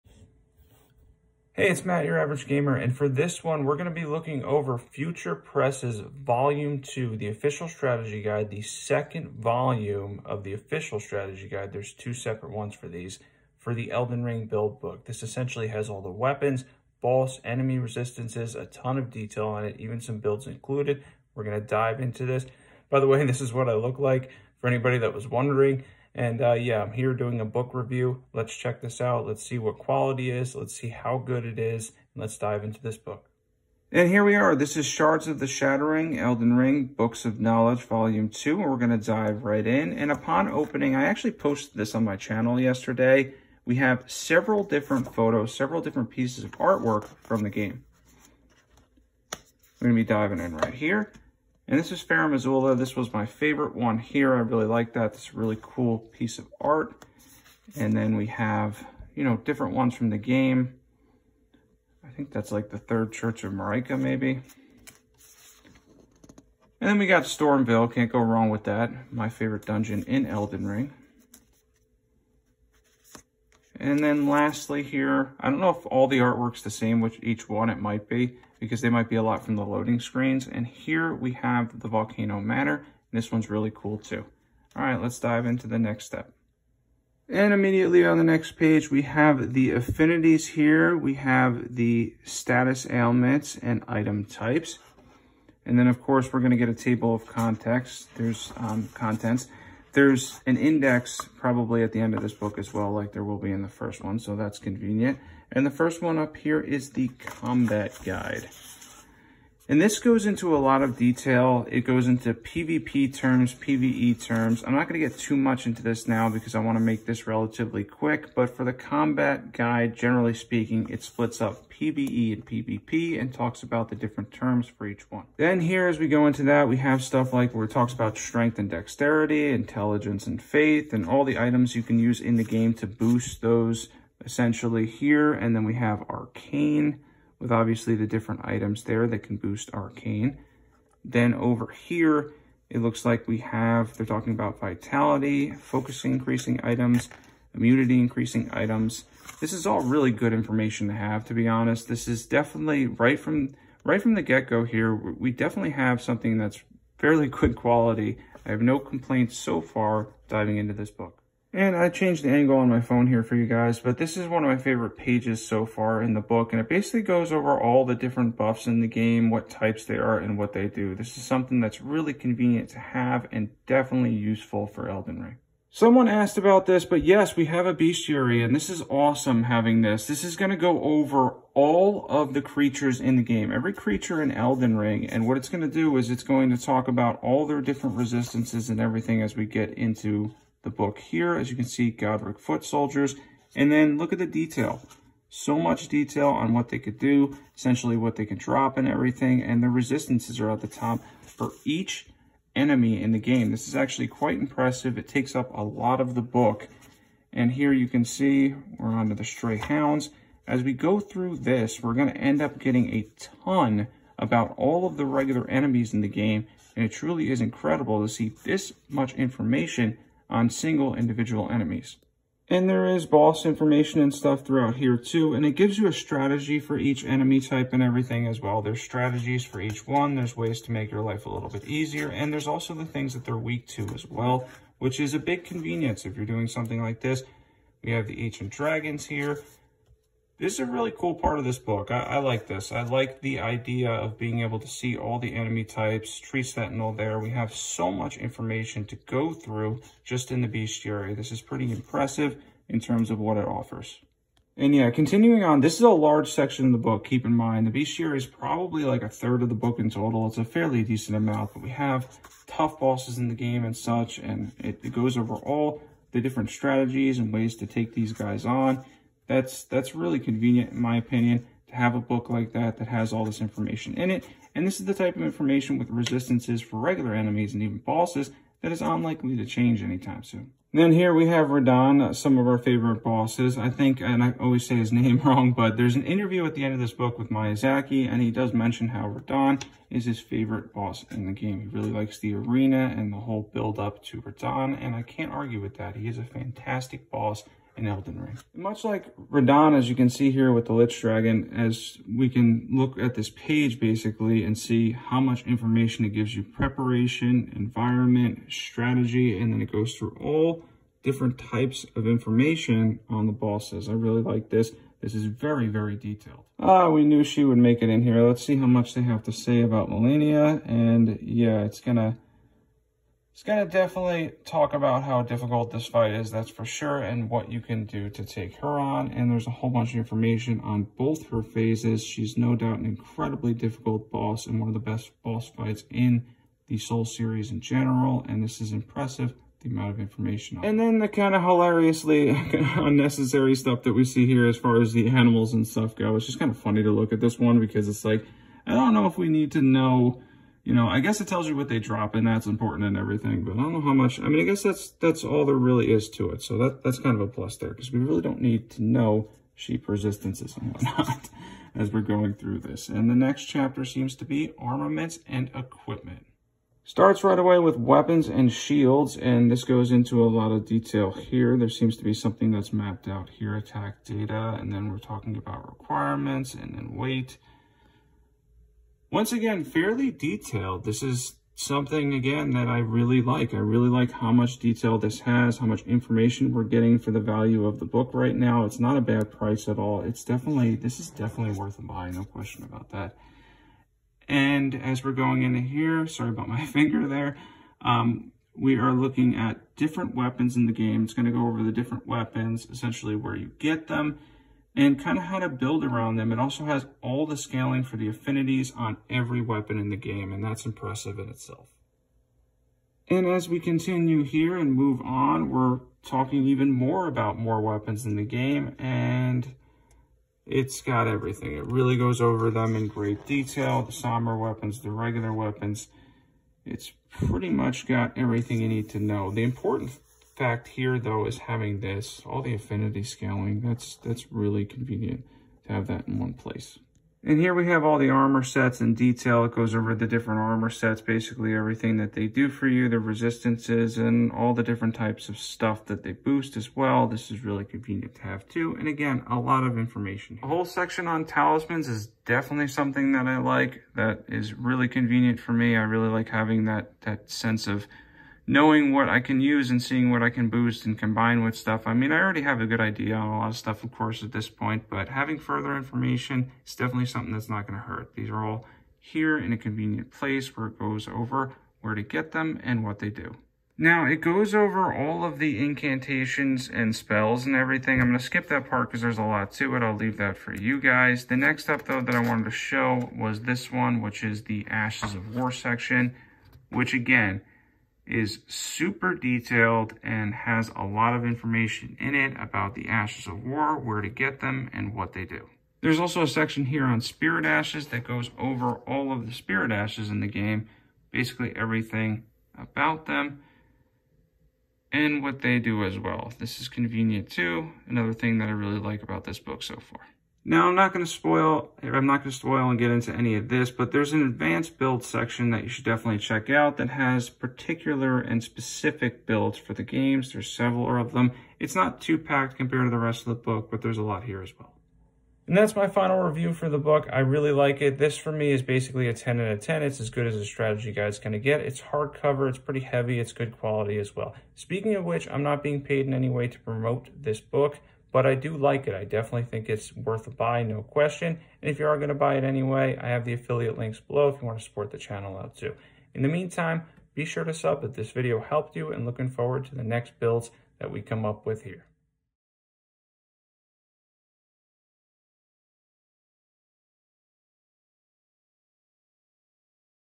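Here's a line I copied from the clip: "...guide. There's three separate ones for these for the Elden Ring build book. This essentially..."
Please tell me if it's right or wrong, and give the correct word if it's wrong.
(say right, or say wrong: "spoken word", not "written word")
wrong: "two", not "three".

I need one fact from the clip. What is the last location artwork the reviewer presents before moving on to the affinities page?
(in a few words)
Volcano Manor.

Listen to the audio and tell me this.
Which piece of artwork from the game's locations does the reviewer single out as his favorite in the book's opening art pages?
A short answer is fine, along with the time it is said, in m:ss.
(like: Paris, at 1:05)
Farum Azula, at 0:52.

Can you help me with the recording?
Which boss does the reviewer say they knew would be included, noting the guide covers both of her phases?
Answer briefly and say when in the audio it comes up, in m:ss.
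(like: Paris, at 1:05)
Malenia, at 5:19.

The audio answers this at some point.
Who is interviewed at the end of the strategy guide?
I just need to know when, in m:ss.
4:47.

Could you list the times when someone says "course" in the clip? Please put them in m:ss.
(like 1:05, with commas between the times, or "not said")
1:36, 7:43.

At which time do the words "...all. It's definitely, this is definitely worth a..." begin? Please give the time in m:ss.
6:29.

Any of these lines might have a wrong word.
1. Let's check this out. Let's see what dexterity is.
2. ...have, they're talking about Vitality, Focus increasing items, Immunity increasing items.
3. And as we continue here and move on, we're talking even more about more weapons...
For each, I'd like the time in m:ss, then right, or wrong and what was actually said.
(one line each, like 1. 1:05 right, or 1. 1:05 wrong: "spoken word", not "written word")
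1. 0:28 wrong: "quality", not "dexterity"
2. 2:23 right
3. 6:53 right.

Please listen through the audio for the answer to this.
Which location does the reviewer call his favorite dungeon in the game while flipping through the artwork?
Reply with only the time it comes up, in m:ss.
1:07.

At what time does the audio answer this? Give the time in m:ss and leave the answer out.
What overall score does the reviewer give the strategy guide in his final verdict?
8:49.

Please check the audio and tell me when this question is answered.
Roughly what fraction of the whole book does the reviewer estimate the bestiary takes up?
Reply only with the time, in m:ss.
4:19.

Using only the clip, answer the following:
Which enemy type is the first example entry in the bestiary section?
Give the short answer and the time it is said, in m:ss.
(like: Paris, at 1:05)
Godrick Foot Soldiers, at 3:11.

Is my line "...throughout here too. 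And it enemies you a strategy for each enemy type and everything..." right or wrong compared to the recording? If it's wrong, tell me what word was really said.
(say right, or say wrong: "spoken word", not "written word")
wrong: "gives", not "enemies".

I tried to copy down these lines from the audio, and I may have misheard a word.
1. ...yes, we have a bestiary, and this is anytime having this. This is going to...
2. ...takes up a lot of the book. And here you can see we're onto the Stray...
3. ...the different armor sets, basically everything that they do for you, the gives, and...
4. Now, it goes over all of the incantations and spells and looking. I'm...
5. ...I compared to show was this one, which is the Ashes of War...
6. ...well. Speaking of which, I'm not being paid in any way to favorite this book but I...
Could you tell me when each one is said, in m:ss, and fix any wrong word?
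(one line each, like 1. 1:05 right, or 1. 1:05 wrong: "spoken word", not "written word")
1. 2:57 wrong: "awesome", not "anytime"
2. 3:25 right
3. 7:19 wrong: "resistances", not "gives"
4. 7:53 wrong: "everything", not "looking"
5. 8:02 wrong: "wanted", not "compared"
6. 8:54 wrong: "promote", not "favorite".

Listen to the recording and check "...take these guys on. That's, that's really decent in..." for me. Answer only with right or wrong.
wrong.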